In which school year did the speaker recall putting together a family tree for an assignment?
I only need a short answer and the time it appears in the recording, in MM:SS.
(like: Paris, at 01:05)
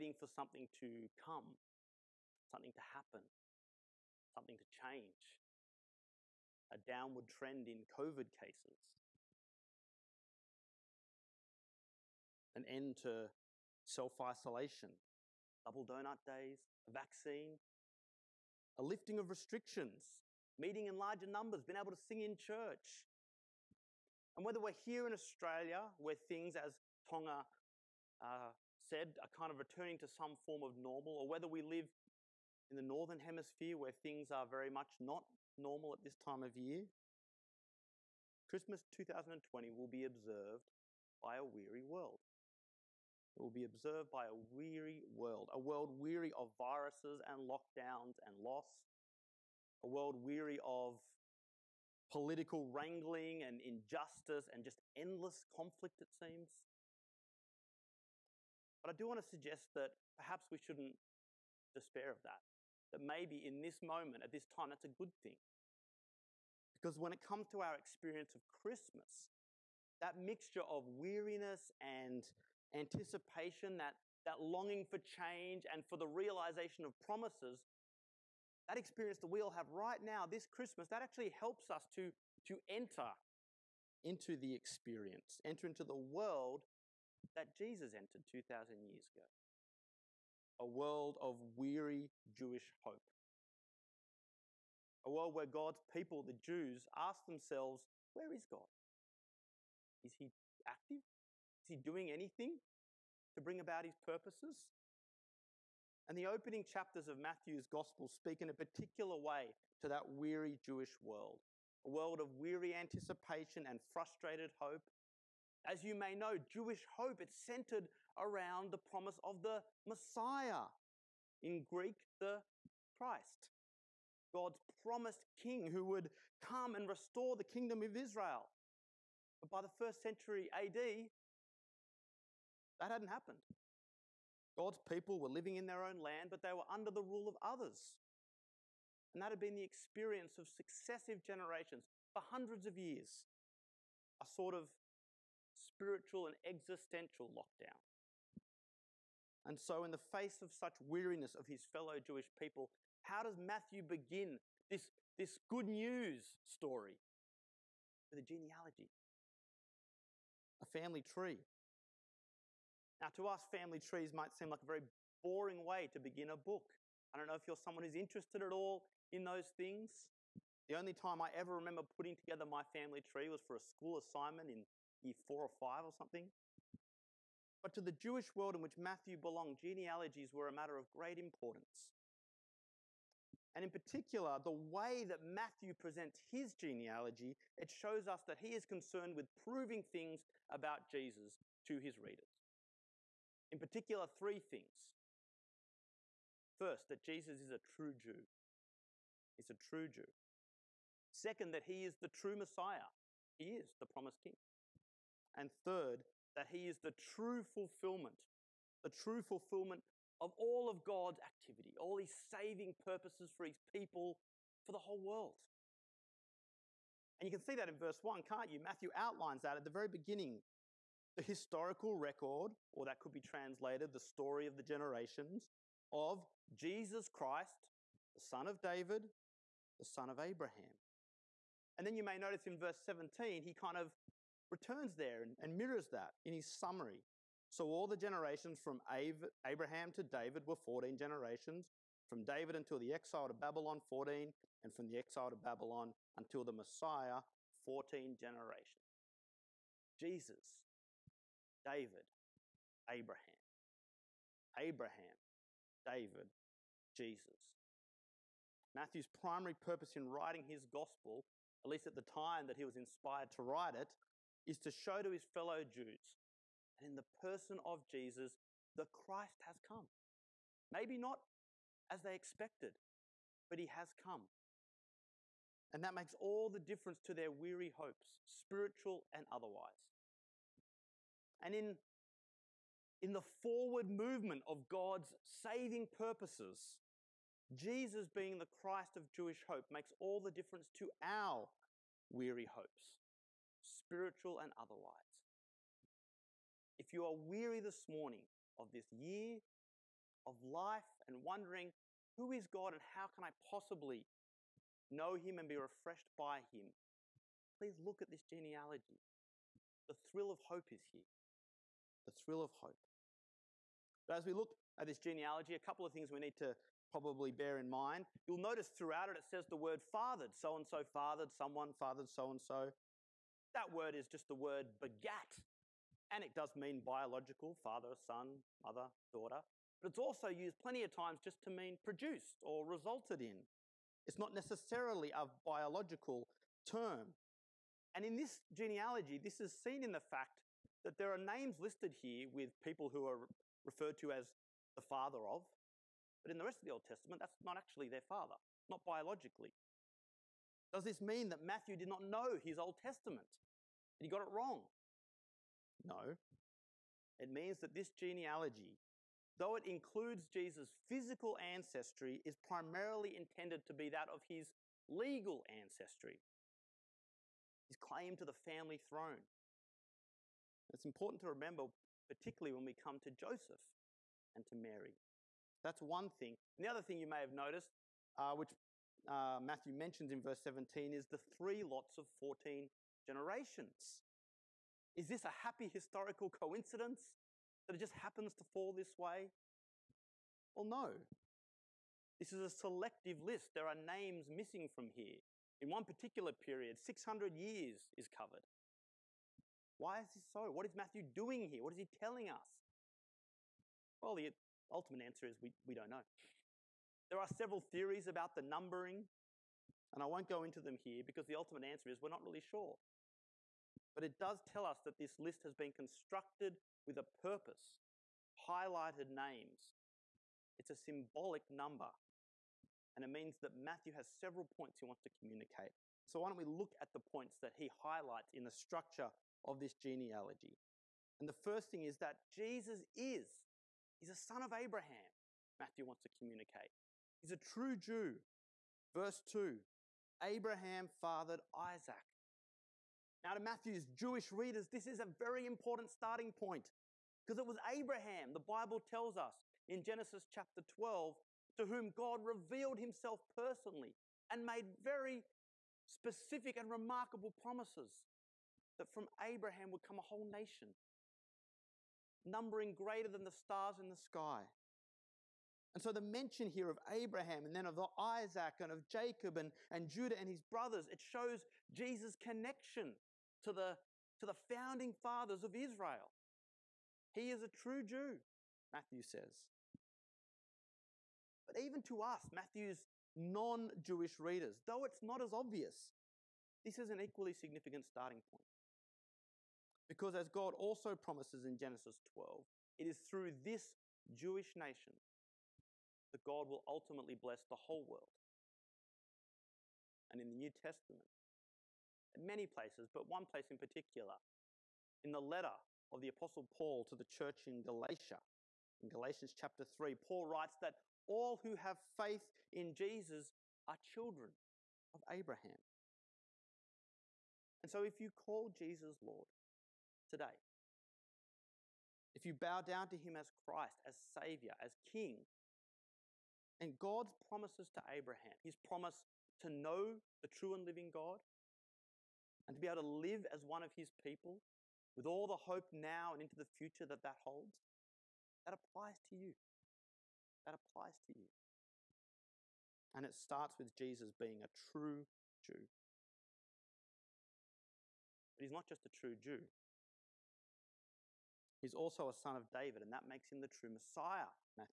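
year 4 or 5, at 02:55.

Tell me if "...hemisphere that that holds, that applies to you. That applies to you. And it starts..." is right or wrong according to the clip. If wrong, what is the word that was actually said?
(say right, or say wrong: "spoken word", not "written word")
wrong: "future", not "hemisphere".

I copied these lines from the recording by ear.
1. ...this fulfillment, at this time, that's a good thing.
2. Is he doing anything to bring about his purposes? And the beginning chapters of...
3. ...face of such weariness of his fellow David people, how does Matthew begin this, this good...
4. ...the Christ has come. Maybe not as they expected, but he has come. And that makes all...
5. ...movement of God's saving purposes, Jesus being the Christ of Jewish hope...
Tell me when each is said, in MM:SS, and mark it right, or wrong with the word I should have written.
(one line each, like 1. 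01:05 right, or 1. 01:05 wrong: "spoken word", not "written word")
1. 01:03 wrong: "moment", not "fulfillment"
2. 01:41 wrong: "opening", not "beginning"
3. 02:29 wrong: "Jewish", not "David"
4. 04:28 right
5. 04:43 right.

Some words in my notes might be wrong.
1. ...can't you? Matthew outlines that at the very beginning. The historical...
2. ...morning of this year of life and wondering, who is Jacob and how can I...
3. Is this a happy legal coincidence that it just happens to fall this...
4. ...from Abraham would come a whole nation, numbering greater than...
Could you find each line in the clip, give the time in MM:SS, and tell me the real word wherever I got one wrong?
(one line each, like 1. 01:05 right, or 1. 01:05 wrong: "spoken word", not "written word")
1. 03:38 right
2. 04:57 wrong: "God", not "Jacob"
3. 06:24 wrong: "historical", not "legal"
4. 07:38 right.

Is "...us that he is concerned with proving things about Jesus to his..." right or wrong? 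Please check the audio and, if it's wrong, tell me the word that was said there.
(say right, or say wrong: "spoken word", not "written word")
right.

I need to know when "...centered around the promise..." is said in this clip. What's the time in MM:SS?
01:57.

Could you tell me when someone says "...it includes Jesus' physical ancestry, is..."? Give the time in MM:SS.
05:59.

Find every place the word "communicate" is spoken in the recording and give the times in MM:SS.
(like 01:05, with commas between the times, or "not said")
07:05, 07:16.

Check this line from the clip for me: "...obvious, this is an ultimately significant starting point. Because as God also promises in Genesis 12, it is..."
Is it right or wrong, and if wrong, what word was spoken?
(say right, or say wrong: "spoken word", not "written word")
wrong: "equally", not "ultimately".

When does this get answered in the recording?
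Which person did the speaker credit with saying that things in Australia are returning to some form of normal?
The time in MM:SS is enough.
00:27.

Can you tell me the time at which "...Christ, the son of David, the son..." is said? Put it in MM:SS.
03:47.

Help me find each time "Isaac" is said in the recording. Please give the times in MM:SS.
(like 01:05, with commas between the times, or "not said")
07:21, 07:47.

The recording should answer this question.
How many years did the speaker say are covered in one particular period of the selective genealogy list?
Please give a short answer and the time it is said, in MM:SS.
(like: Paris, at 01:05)
600, at 06:36.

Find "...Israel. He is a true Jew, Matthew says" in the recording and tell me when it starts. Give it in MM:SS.
07:55.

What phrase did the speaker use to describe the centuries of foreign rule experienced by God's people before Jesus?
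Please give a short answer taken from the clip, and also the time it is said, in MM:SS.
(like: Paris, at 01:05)
spiritual and existential lockdown, at 02:25.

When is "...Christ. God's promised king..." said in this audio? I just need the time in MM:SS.
02:02.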